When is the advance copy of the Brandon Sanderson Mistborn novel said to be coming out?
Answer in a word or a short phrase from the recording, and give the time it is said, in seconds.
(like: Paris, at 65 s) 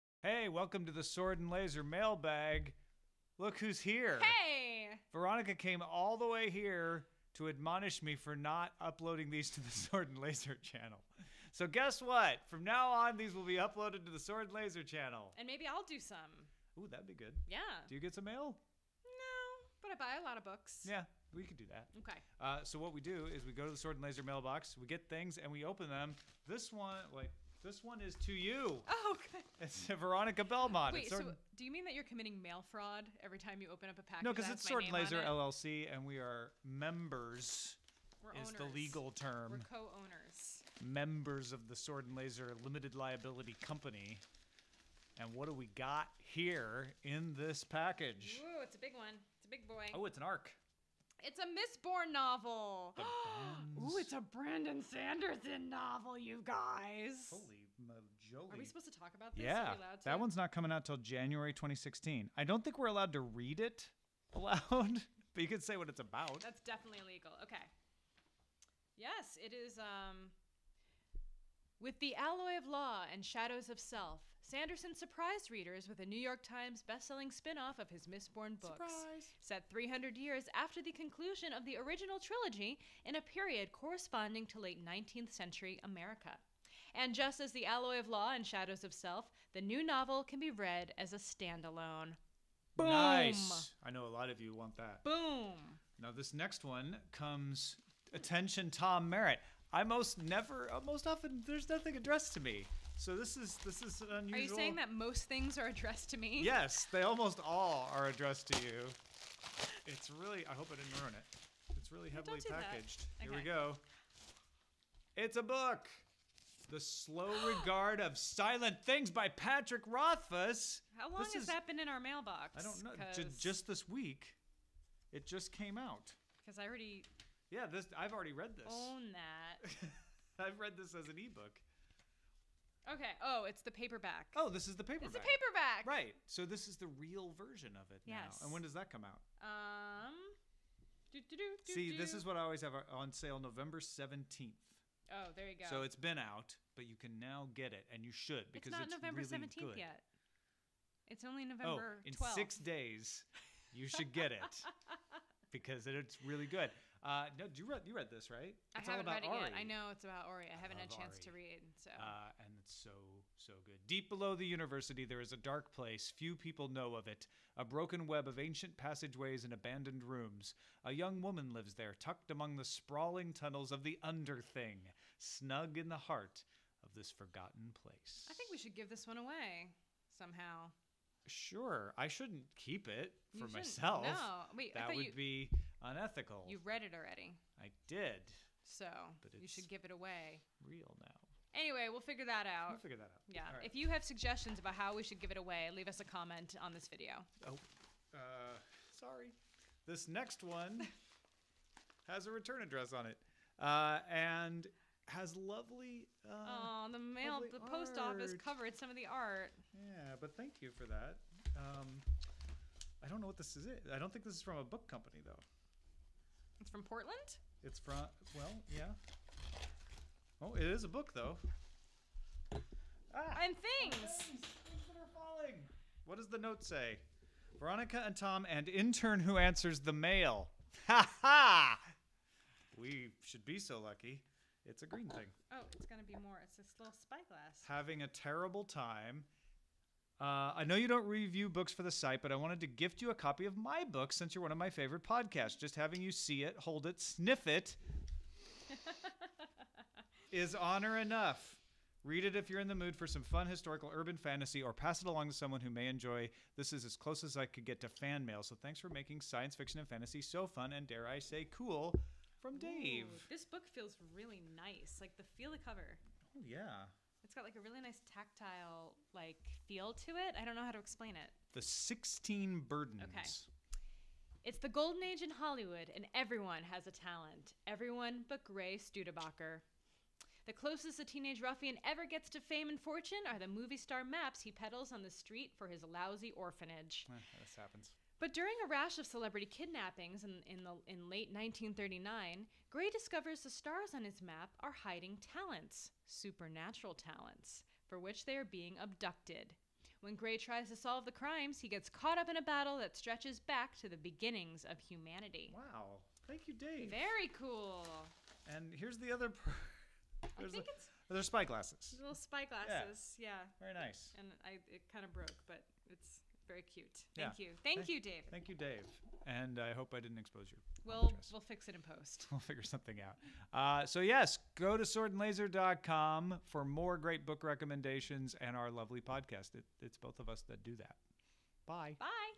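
January 2016, at 60 s.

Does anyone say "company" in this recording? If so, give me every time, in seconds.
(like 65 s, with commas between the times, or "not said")
43 s, 214 s.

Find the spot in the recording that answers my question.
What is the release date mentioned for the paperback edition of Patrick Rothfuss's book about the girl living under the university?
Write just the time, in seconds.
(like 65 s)
143 s.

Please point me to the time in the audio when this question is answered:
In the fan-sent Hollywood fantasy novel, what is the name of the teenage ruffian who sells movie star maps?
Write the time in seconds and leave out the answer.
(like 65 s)
278 s.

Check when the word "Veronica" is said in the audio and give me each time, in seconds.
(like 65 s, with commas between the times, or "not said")
5 s, 29 s, 227 s.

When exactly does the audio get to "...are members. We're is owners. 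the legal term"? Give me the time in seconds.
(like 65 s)
36 s.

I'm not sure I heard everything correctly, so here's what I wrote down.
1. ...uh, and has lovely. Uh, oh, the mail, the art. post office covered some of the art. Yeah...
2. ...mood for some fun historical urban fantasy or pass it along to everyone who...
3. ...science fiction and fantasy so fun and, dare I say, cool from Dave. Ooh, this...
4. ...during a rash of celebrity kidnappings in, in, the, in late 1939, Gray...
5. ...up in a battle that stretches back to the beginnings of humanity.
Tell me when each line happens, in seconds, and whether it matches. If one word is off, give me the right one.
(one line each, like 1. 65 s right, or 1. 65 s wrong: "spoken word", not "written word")
1. 203 s right
2. 252 s wrong: "someone", not "everyone"
3. 259 s right
4. 288 s right
5. 302 s right.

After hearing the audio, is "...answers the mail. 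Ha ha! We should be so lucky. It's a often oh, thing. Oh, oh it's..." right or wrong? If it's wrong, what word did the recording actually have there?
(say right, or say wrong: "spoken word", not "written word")
wrong: "green", not "often".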